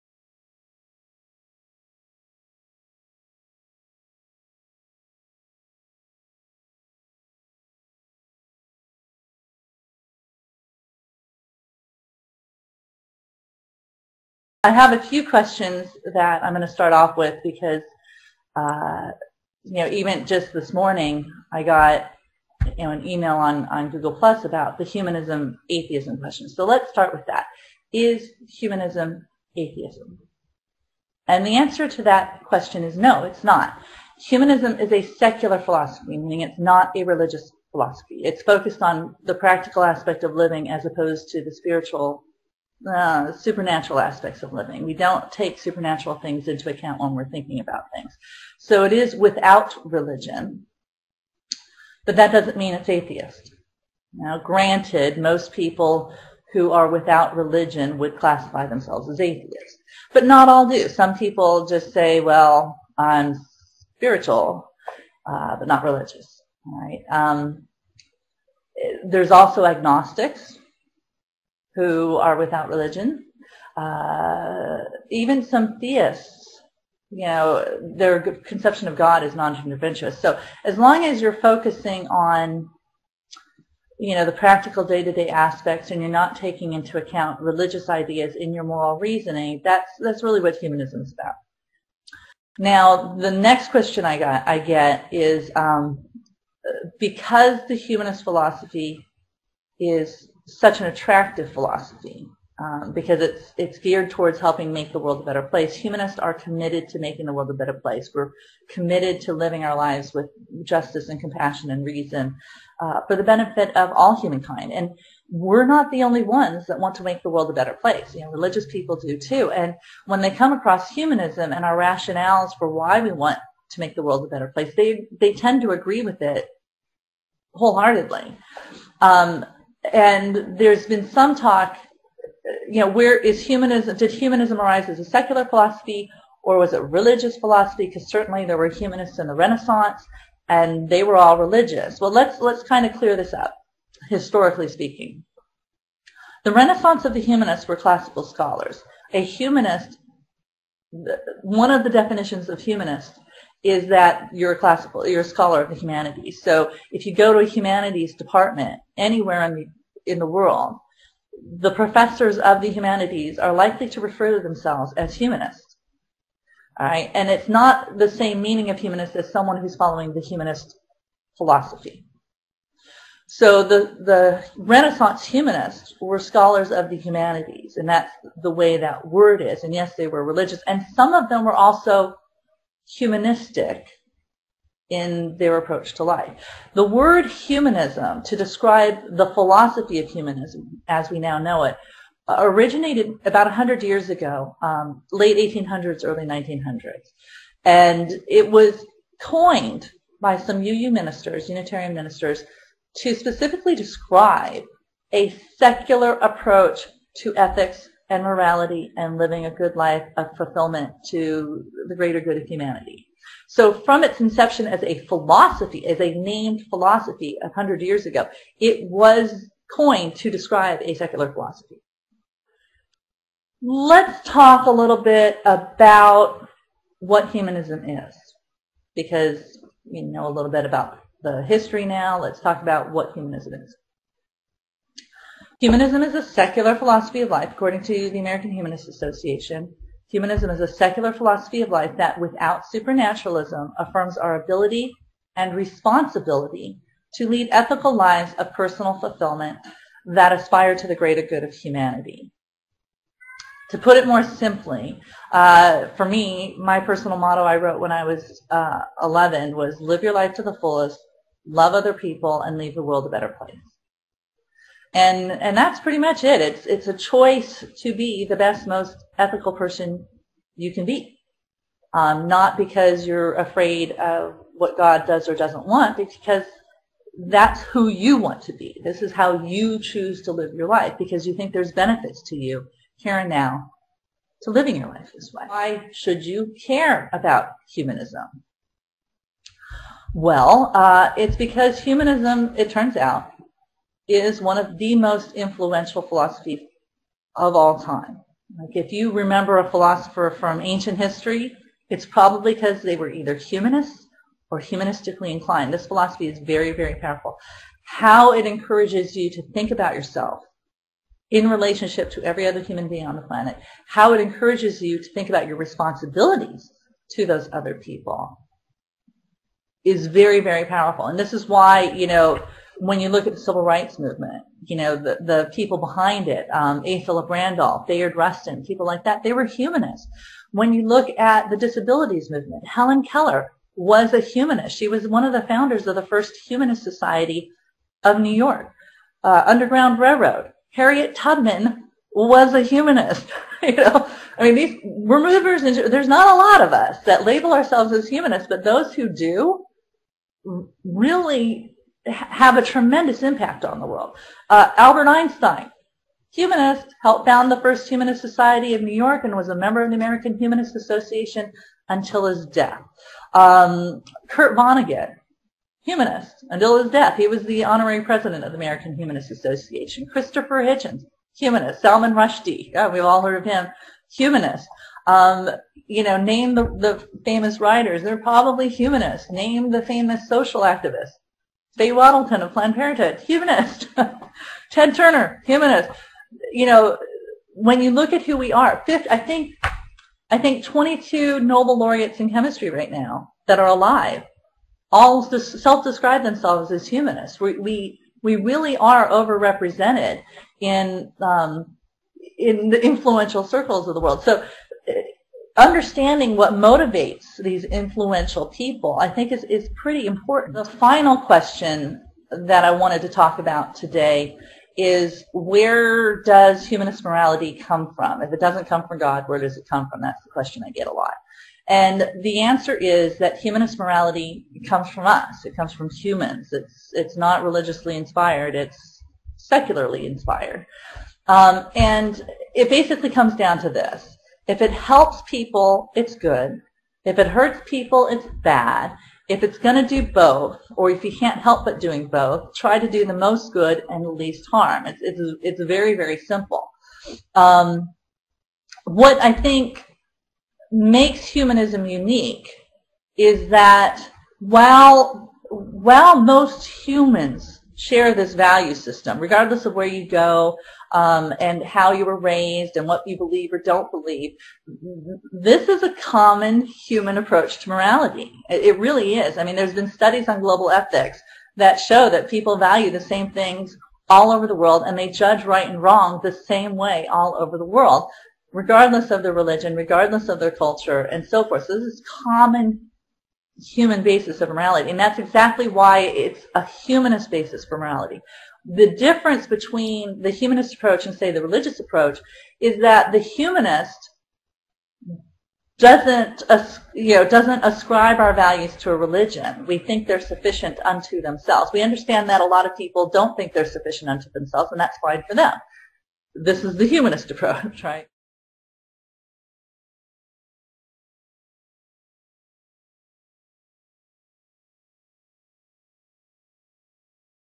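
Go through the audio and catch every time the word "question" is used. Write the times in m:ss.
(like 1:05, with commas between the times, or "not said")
0:15, 0:26, 0:32, 1:33, 6:51, 7:00.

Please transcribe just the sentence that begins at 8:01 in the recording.
So this is common human basis of morality.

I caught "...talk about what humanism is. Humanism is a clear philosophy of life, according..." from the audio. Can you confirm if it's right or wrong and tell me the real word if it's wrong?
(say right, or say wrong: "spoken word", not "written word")
wrong: "secular", not "clear".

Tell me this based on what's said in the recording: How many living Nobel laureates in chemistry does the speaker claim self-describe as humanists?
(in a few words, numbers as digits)
22.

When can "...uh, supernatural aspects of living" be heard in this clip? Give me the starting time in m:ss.
0:42.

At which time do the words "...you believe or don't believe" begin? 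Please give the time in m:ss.
7:43.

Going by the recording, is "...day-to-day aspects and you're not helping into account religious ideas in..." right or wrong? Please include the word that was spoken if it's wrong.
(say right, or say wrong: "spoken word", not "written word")
wrong: "taking", not "helping".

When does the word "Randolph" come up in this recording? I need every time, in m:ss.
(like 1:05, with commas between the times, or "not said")
5:27.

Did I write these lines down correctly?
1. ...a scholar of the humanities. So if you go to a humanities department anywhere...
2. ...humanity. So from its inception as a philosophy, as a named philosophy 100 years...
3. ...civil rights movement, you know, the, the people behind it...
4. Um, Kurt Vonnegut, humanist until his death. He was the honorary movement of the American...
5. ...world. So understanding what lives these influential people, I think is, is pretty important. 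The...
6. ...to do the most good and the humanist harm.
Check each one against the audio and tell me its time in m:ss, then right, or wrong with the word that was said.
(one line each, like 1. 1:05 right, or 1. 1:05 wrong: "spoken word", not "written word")
1. 2:35 right
2. 3:32 right
3. 5:23 right
4. 6:03 wrong: "president", not "movement"
5. 6:44 wrong: "motivates", not "lives"
6. 7:22 wrong: "least", not "humanist".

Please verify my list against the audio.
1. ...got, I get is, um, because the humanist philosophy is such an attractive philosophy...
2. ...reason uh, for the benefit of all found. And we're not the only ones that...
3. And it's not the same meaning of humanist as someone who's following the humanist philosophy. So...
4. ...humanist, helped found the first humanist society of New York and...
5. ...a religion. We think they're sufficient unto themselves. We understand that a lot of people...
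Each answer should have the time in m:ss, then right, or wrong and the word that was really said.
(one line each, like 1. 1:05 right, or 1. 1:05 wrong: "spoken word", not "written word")
1. 1:34 right
2. 1:51 wrong: "humankind", not "found"
3. 2:47 right
4. 5:56 right
5. 8:18 right.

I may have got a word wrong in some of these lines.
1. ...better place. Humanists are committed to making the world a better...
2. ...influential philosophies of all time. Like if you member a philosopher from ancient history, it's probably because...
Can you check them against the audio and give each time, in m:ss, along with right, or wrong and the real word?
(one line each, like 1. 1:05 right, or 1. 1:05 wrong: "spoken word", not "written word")
1. 1:45 right
2. 4:55 wrong: "remember", not "member".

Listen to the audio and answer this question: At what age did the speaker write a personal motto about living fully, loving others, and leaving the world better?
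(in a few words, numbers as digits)
11.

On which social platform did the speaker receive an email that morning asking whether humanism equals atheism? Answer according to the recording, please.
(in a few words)
Google Plus.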